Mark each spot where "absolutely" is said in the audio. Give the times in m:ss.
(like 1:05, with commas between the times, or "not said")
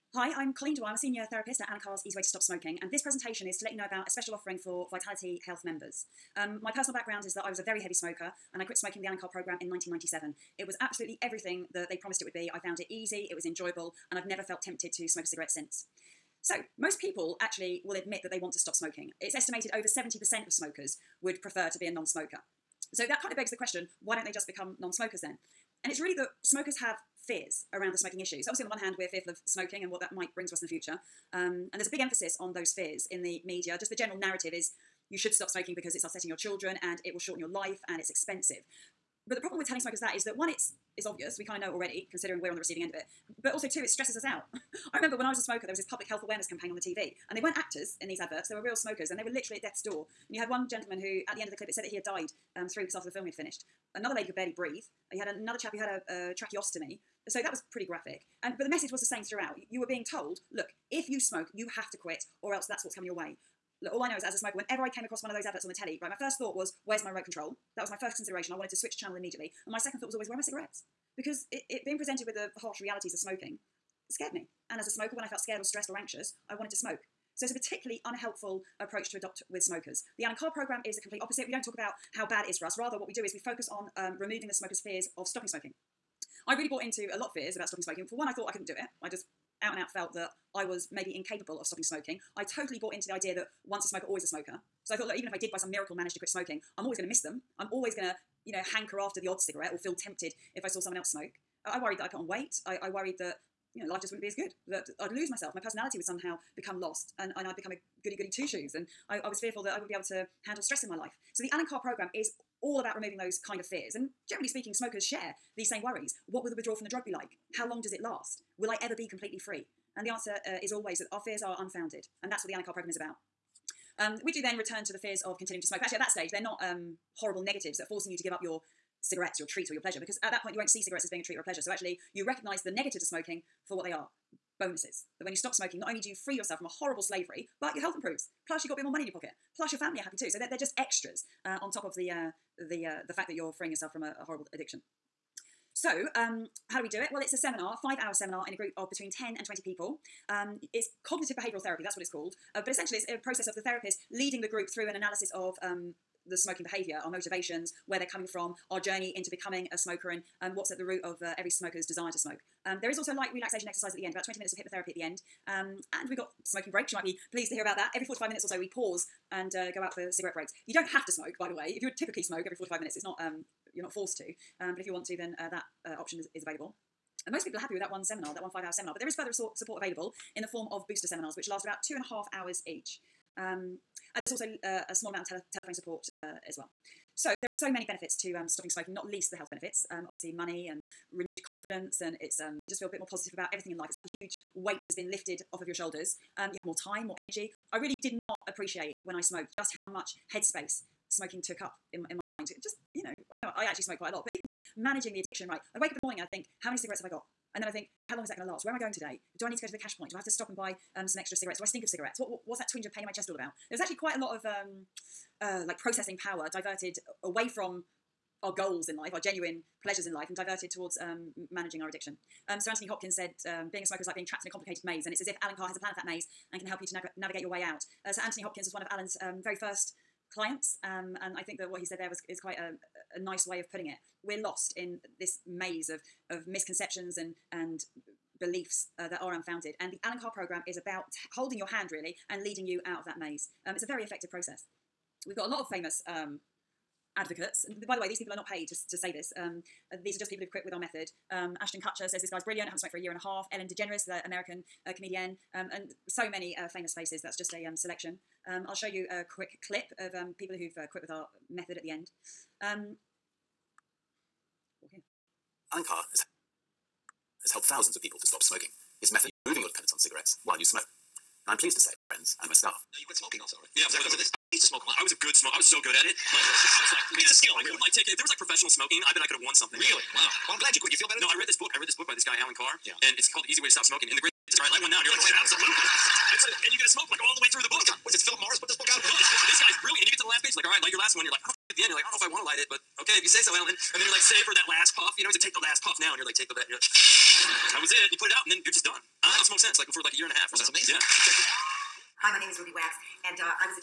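0:10, 4:45.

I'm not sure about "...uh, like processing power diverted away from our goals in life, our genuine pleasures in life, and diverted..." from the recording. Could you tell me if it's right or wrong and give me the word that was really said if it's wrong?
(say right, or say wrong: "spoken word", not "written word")
right.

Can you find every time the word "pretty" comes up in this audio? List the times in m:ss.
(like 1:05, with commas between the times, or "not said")
0:57.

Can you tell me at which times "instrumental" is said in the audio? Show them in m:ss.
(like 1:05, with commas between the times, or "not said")
not said.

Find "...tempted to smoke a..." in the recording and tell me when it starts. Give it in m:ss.
0:14.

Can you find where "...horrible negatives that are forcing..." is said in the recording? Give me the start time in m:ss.
2:07.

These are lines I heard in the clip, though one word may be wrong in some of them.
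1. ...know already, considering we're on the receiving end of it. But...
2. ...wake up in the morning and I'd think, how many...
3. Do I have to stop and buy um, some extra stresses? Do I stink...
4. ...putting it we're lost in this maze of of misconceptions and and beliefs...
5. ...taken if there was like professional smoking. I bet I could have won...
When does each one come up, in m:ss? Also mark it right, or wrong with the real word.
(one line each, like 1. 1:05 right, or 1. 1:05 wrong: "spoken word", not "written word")
1. 0:41 right
2. 3:25 right
3. 3:30 wrong: "cigarettes", not "stresses"
4. 3:53 right
5. 4:37 right.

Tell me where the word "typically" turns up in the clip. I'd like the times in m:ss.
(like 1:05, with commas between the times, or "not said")
2:51.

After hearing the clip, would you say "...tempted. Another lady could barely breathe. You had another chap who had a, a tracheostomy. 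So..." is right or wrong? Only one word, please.
wrong.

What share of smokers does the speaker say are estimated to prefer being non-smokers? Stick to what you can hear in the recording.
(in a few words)
over 70%.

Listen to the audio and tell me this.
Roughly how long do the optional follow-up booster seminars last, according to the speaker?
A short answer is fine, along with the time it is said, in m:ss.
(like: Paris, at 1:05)
2.5 hours, at 3:01.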